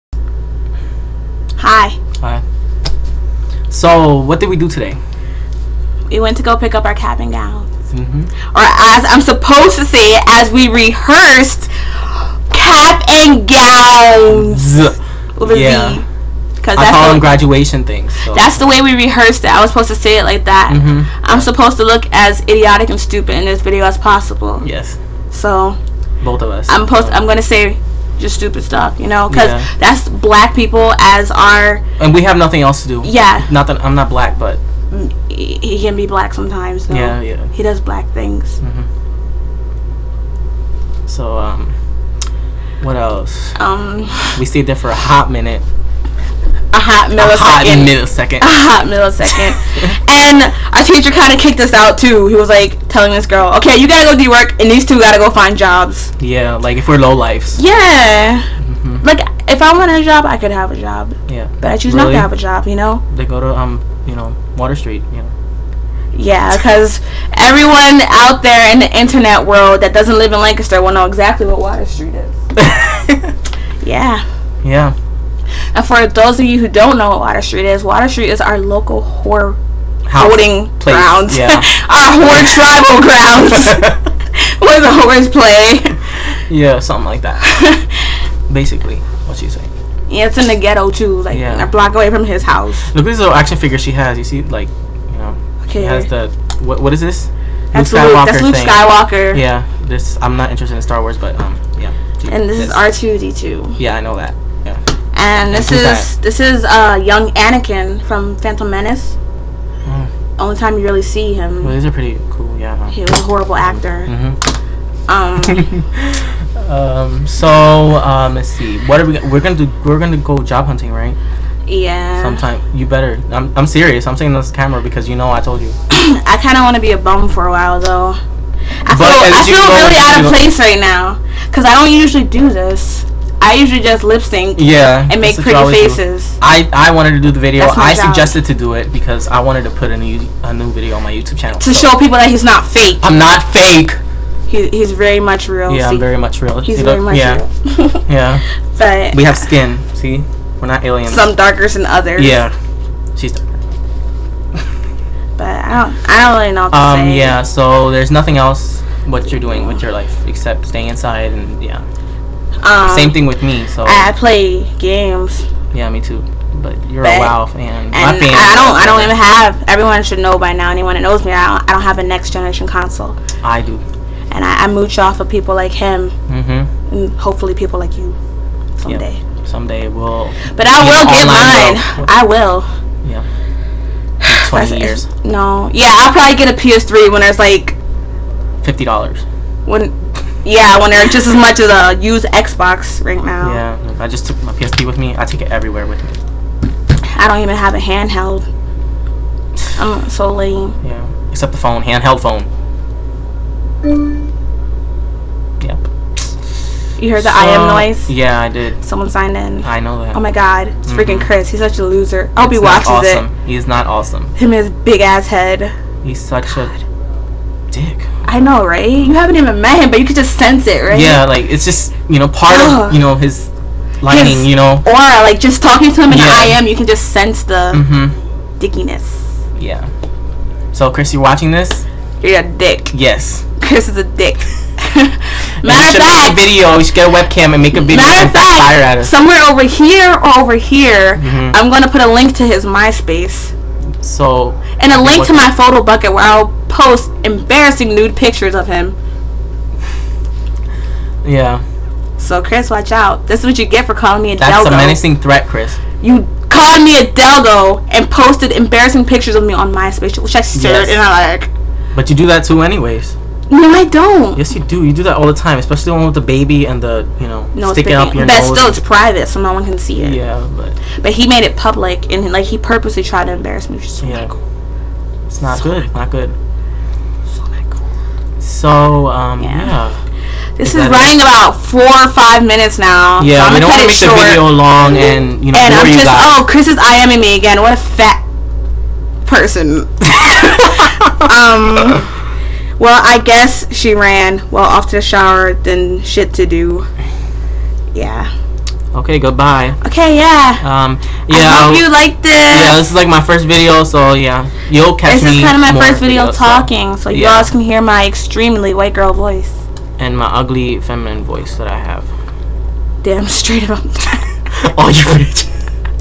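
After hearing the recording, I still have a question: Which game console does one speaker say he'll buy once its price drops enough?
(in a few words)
PS3.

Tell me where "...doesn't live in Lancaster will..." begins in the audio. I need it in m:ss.
1:09.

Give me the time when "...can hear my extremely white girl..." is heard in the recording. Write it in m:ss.
5:07.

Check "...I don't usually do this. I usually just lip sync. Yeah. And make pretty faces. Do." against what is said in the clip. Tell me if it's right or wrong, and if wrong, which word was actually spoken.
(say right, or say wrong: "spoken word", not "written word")
right.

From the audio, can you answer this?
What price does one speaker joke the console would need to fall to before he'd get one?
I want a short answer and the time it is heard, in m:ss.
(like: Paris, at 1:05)
$50, at 3:08.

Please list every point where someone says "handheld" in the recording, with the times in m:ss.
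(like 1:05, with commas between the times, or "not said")
3:17, 3:21.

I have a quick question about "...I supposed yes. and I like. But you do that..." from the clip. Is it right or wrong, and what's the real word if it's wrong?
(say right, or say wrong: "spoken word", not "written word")
wrong: "stared", not "supposed".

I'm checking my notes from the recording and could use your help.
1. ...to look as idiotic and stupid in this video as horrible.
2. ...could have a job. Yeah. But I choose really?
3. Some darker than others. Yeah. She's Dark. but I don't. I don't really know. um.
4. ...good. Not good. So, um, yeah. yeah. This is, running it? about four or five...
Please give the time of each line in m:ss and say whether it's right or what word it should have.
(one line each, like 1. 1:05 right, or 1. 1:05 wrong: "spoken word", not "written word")
1. 0:21 wrong: "possible", not "horrible"
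2. 1:00 right
3. 2:31 right
4. 4:35 right.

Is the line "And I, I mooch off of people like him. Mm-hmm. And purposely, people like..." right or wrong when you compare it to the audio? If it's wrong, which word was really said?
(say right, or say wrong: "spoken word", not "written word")
wrong: "hopefully", not "purposely".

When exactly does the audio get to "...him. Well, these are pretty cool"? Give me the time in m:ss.
1:51.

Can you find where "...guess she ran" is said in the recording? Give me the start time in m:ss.
4:53.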